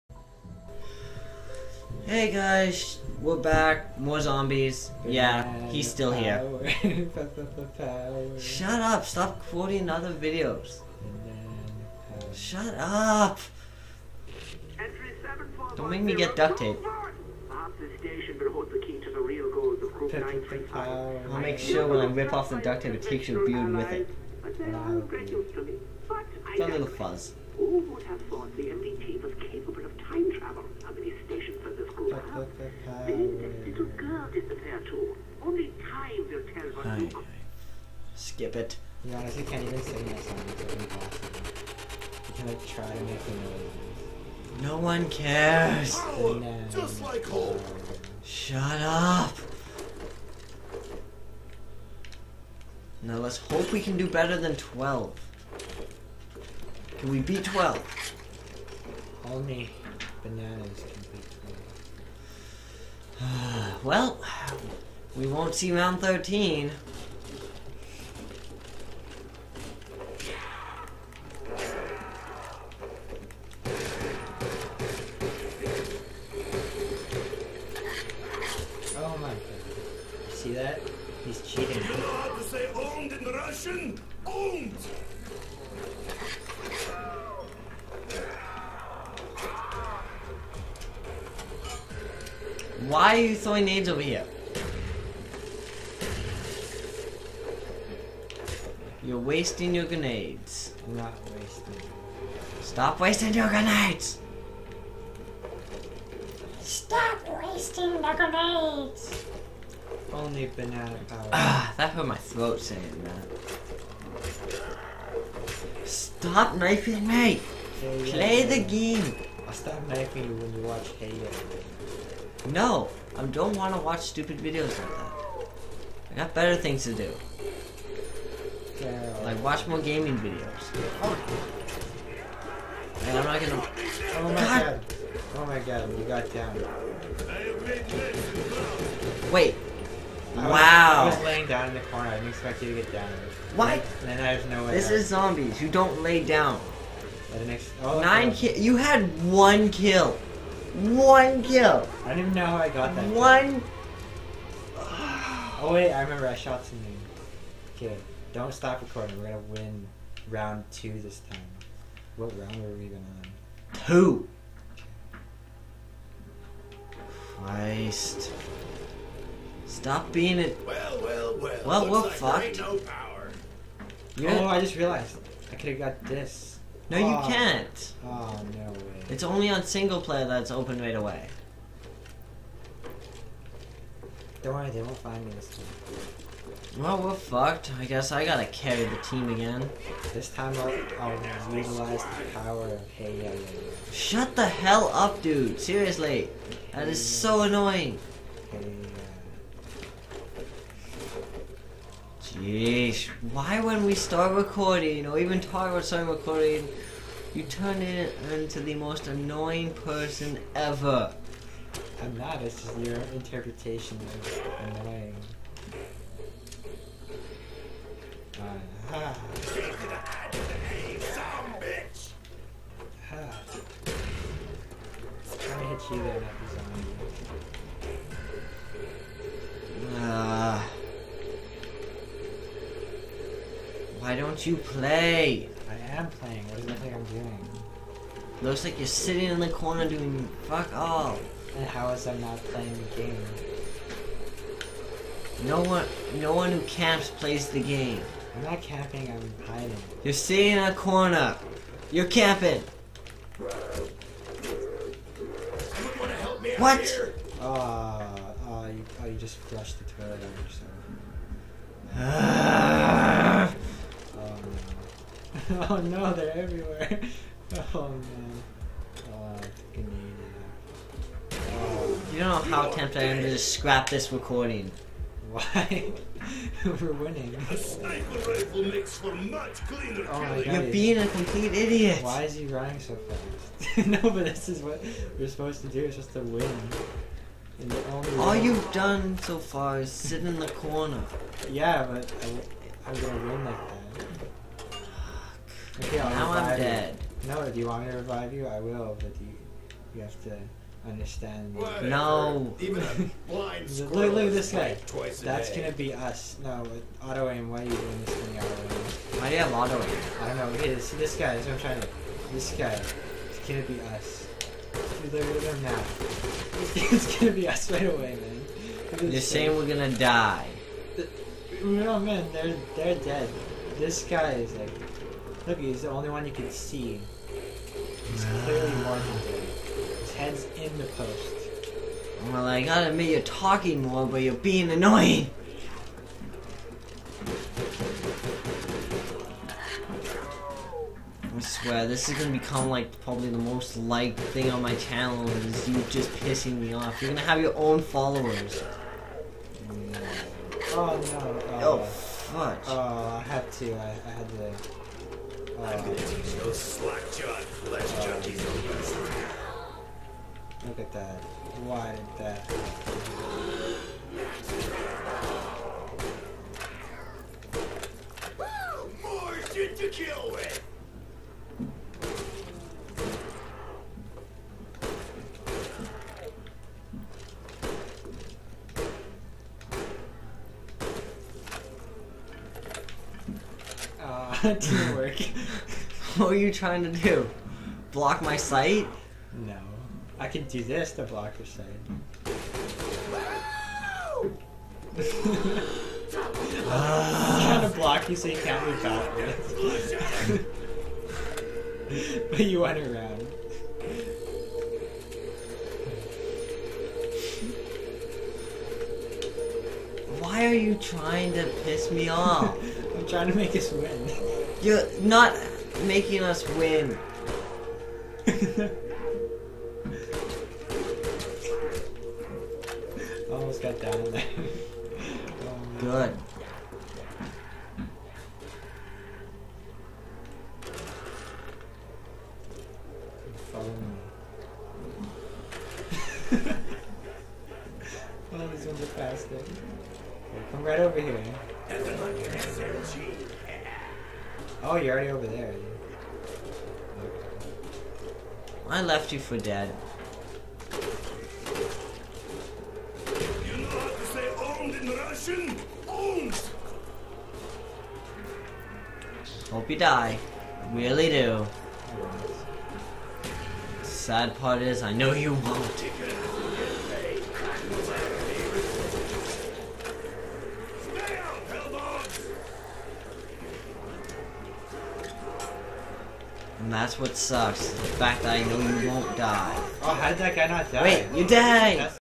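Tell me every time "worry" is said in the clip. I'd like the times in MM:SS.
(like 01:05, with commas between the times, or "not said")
03:04.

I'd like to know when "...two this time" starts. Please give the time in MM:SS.
02:40.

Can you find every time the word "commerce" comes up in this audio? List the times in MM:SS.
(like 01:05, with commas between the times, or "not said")
not said.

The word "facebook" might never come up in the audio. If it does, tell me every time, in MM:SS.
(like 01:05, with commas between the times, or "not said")
not said.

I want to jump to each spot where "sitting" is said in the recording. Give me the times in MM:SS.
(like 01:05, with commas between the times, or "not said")
03:58, 04:10.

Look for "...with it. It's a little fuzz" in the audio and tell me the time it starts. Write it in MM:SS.
00:23.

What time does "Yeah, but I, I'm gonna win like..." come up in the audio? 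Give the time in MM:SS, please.
04:51.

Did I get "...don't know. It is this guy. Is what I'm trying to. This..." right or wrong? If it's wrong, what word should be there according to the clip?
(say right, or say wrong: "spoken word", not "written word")
right.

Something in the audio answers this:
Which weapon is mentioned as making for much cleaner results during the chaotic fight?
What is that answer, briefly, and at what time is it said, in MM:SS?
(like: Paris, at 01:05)
sniper rifle, at 04:37.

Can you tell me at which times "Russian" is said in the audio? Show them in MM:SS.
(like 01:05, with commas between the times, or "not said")
01:23, 07:34.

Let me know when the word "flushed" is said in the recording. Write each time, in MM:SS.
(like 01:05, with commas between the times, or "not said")
04:19.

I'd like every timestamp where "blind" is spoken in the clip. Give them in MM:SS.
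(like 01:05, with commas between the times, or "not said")
05:03.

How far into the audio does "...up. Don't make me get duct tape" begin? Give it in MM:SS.
00:12.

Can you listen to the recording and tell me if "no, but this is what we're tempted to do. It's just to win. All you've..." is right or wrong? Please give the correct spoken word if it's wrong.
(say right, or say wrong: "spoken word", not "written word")
wrong: "supposed", not "tempted".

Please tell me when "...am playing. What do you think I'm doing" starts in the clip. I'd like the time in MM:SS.
03:55.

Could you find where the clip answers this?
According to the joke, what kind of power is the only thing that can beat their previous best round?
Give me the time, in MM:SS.
00:59.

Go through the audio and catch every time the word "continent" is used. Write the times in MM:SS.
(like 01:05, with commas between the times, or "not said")
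not said.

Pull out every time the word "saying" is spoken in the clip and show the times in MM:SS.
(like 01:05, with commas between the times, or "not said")
01:52, 05:19.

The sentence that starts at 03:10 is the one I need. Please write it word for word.
This time I'll, I'll utilize the power of hey yeah yeah yeah.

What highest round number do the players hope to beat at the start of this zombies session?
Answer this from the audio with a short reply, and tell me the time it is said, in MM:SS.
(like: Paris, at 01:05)
12, at 00:56.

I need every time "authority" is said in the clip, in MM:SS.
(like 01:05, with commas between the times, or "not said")
not said.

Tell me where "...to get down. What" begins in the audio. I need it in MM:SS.
02:22.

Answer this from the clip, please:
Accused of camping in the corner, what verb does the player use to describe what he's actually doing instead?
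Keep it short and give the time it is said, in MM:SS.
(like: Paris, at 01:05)
hiding, at 04:09.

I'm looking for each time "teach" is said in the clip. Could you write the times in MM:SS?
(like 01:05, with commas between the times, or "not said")
05:55.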